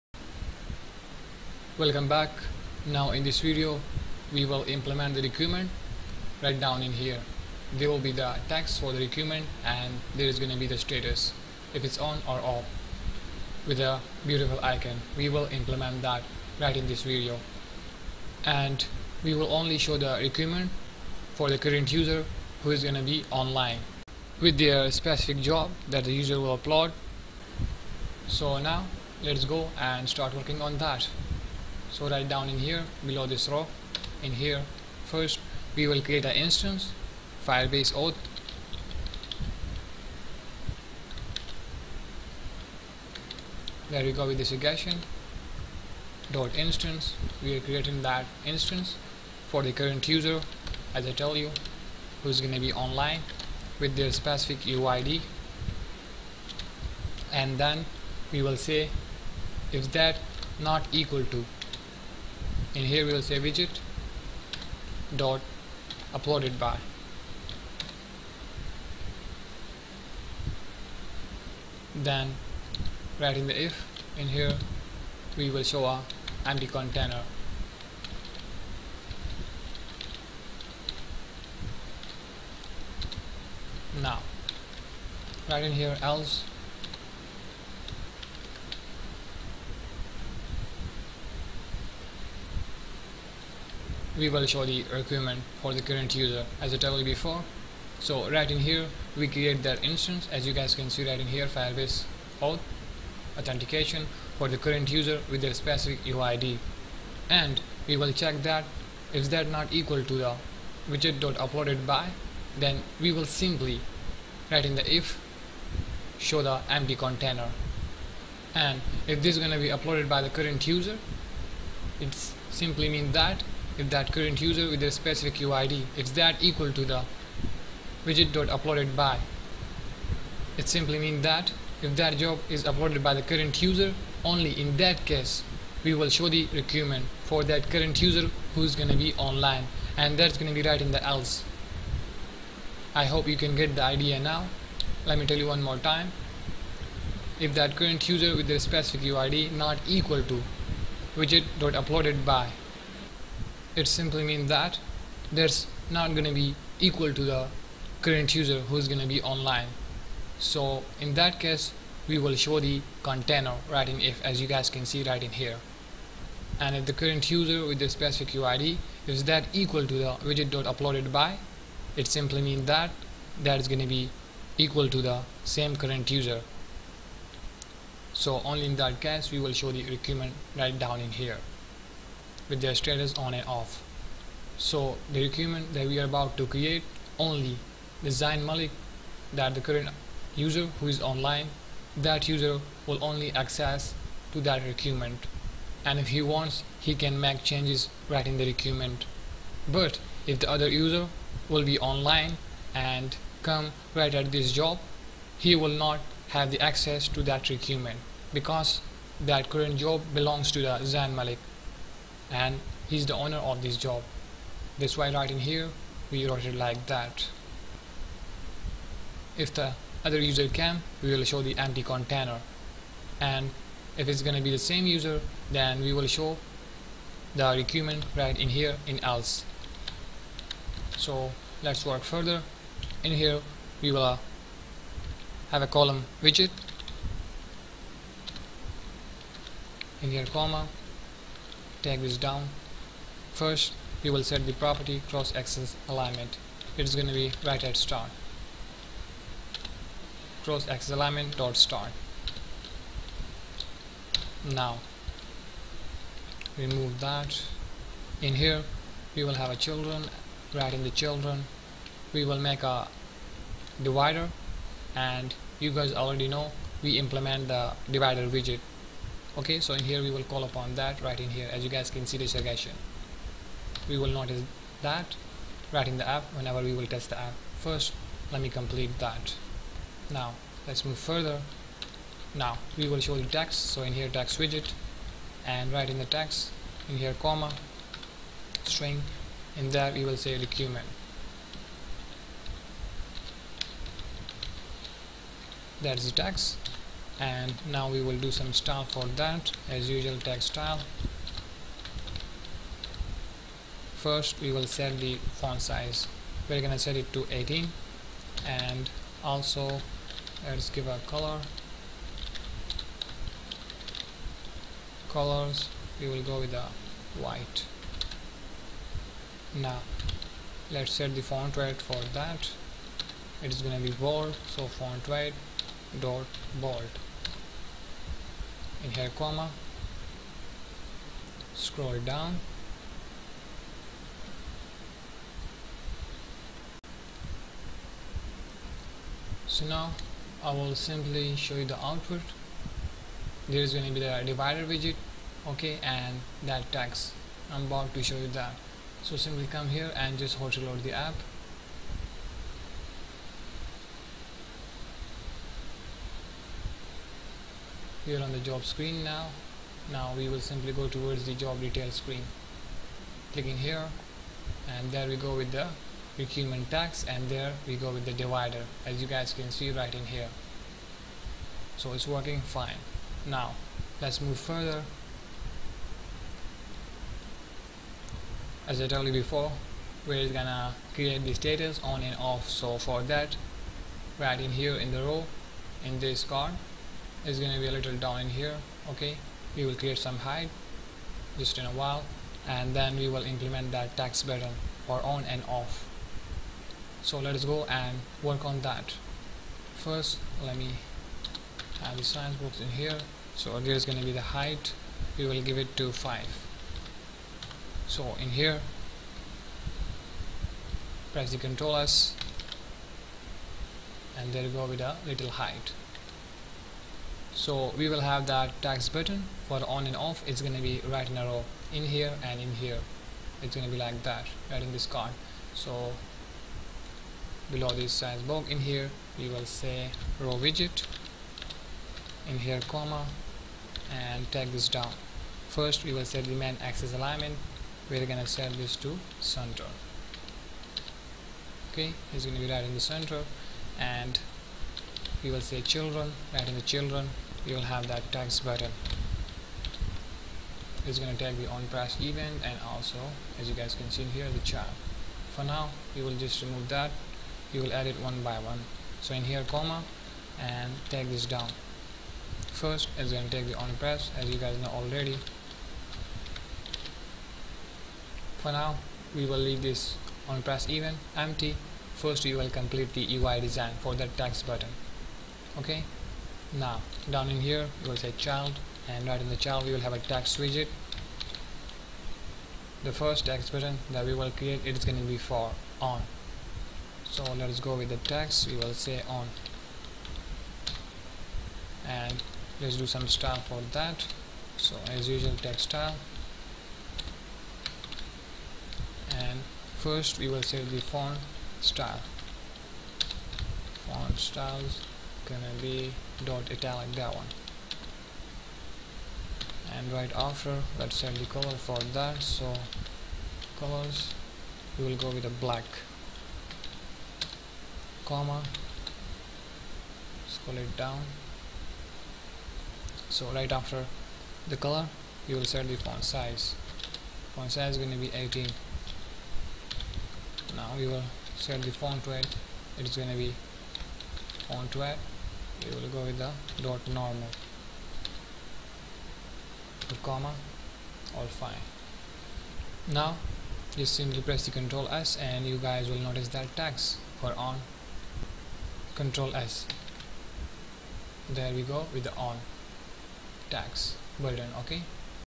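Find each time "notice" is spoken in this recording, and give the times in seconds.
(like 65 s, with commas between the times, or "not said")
274 s, 546 s.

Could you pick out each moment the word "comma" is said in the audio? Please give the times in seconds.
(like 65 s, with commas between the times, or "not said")
240 s, 287 s, 329 s, 432 s, 459 s, 518 s, 540 s.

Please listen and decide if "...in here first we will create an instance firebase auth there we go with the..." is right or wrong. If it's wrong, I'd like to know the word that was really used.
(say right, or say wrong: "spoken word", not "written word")
right.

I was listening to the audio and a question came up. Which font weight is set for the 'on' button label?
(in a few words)
normal.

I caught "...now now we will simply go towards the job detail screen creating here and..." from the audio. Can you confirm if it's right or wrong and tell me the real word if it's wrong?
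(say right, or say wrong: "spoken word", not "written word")
wrong: "clicking", not "creating".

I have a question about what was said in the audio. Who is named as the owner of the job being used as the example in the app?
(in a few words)
Zan Malik.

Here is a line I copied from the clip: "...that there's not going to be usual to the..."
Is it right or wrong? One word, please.
wrong.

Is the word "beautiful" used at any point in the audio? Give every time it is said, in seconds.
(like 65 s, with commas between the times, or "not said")
14 s.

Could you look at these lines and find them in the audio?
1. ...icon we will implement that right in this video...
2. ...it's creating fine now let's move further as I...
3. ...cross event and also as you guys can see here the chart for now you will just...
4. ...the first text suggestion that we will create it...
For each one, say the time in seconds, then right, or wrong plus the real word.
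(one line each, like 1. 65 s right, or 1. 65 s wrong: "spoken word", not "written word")
1. 14 s right
2. 371 s wrong: "working", not "creating"
3. 451 s wrong: "press", not "cross"
4. 482 s wrong: "button", not "suggestion".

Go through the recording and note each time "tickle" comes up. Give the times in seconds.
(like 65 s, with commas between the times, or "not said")
not said.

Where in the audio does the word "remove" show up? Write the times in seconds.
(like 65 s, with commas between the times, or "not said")
256 s, 456 s.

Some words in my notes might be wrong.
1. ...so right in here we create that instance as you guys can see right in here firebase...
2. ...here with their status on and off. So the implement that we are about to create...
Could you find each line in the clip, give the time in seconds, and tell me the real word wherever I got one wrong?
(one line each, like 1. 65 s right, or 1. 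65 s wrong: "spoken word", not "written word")
1. 97 s right
2. 181 s wrong: "requirement", not "implement".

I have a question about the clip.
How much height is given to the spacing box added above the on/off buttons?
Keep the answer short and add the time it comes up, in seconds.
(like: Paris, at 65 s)
5, at 405 s.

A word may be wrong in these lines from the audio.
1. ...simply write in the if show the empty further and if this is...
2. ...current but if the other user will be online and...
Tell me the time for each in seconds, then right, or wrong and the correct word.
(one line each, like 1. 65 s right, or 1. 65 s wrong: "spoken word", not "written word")
1. 113 s wrong: "container", not "further"
2. 198 s wrong: "requirement", not "current".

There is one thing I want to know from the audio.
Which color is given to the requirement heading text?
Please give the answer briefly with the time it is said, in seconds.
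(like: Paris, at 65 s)
white, at 317 s.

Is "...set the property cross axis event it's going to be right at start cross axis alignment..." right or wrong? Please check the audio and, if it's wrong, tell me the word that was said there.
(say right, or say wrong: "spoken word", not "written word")
wrong: "alignment", not "event".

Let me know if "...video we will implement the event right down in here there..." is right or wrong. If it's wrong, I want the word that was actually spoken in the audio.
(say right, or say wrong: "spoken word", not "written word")
wrong: "requirement", not "event".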